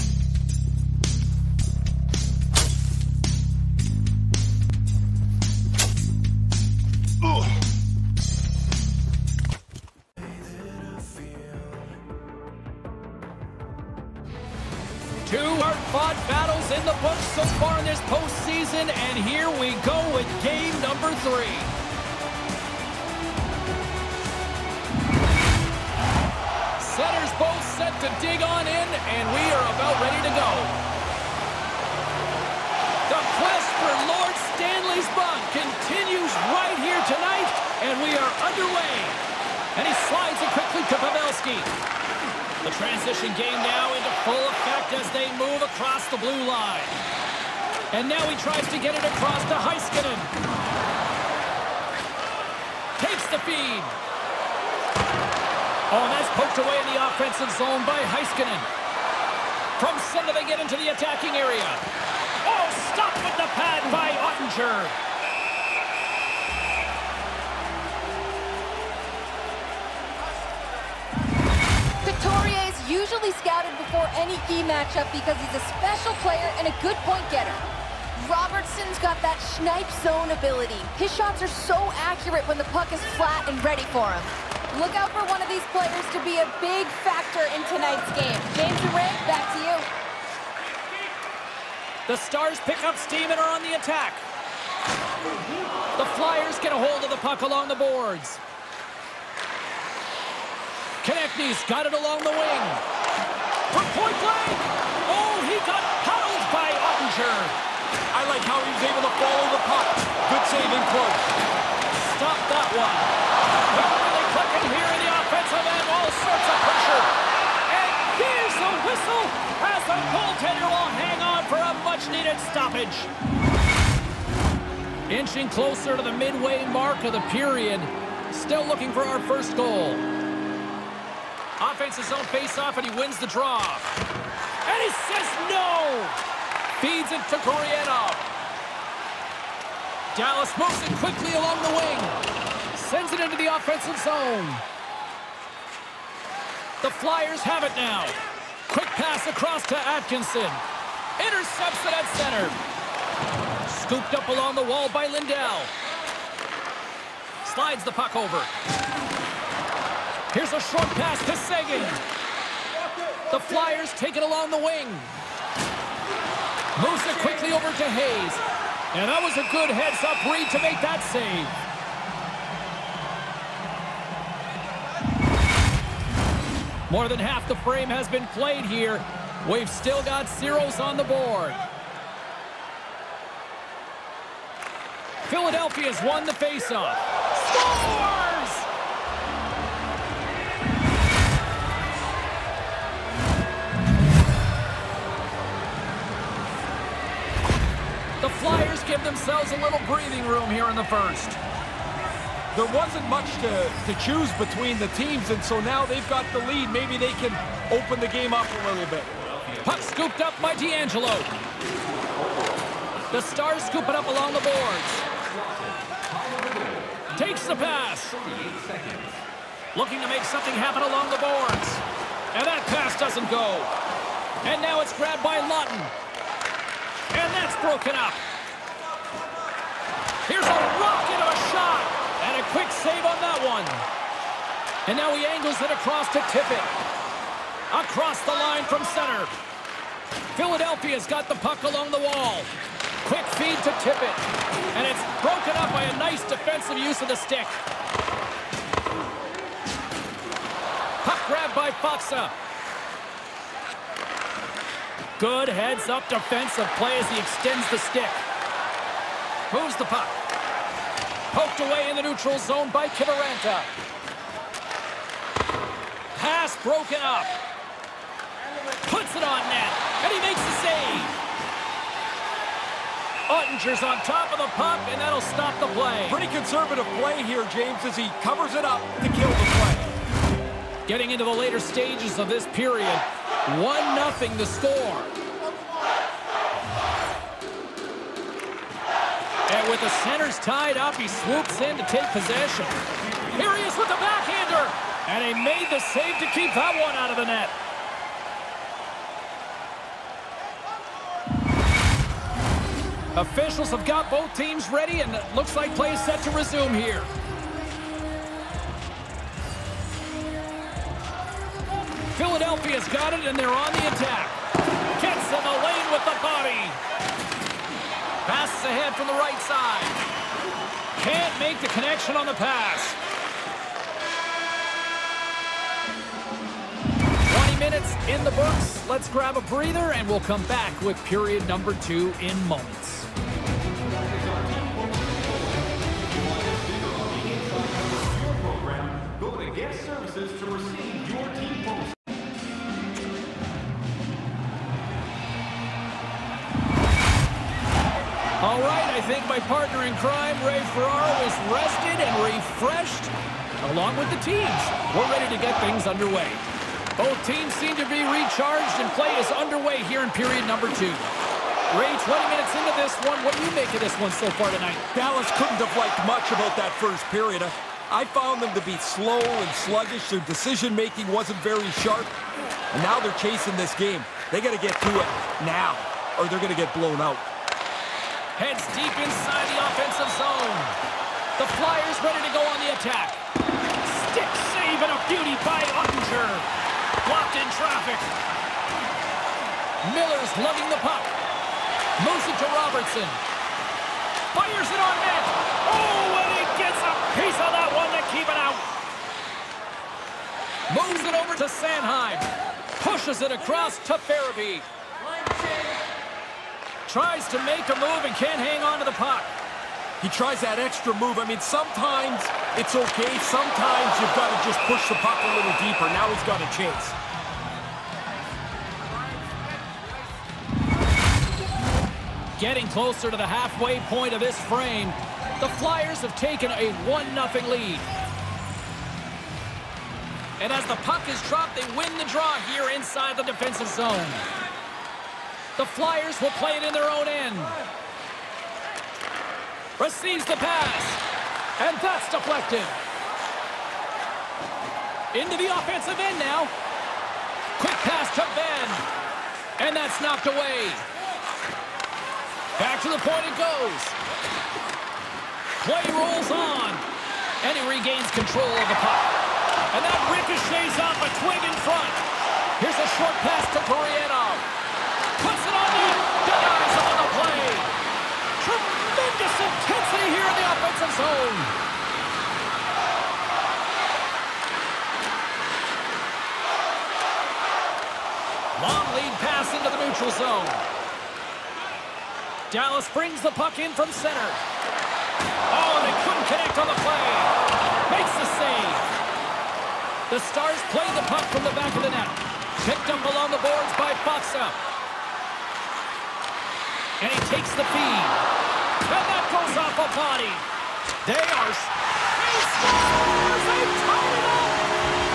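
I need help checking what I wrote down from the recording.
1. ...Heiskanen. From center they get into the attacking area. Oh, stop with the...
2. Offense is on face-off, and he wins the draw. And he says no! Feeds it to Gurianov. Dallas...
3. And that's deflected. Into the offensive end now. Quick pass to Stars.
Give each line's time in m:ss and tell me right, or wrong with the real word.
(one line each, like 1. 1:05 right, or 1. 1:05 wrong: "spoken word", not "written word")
1. 0:58 right
2. 2:11 right
3. 7:21 wrong: "Benn", not "Stars".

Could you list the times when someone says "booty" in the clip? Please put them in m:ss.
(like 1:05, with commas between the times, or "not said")
not said.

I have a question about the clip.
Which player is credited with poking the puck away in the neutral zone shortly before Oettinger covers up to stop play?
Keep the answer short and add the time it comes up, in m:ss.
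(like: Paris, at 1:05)
Kiviranta, at 4:22.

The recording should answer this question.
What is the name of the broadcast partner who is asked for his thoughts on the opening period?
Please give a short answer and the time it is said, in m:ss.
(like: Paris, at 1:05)
Ray Ferraro, at 5:50.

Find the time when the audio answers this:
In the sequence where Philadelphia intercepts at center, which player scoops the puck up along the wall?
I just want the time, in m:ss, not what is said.
2:35.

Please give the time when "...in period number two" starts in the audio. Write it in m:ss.
6:00.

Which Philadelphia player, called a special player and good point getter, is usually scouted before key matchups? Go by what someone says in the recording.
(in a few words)
Couturier.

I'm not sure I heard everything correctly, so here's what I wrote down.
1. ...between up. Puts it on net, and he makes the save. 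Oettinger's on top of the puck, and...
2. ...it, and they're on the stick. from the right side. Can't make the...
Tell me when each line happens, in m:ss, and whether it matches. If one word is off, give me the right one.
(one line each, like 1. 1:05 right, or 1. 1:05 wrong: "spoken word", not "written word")
1. 4:26 wrong: "broken", not "between"
2. 5:13 wrong: "attack", not "stick".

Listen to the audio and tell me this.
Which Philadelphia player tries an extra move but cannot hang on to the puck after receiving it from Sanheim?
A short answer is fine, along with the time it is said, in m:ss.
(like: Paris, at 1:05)
Farabee, at 6:44.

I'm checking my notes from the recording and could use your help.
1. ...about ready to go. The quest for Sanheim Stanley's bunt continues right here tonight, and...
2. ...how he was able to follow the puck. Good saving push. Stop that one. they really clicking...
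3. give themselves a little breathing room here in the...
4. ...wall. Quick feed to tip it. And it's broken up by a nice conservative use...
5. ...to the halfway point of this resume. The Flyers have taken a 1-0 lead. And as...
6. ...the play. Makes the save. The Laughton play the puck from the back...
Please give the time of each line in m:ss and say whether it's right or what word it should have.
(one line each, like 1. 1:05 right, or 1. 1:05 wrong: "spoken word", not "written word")
1. 0:29 wrong: "Lord", not "Sanheim"
2. 1:48 right
3. 3:18 right
4. 4:02 wrong: "defensive", not "conservative"
5. 7:03 wrong: "frame", not "resume"
6. 8:06 wrong: "Stars", not "Laughton".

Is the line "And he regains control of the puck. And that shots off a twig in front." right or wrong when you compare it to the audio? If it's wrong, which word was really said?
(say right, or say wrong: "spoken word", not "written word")
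wrong: "ricochets", not "shots".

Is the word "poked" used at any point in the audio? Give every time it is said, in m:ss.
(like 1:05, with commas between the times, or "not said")
0:56, 4:21.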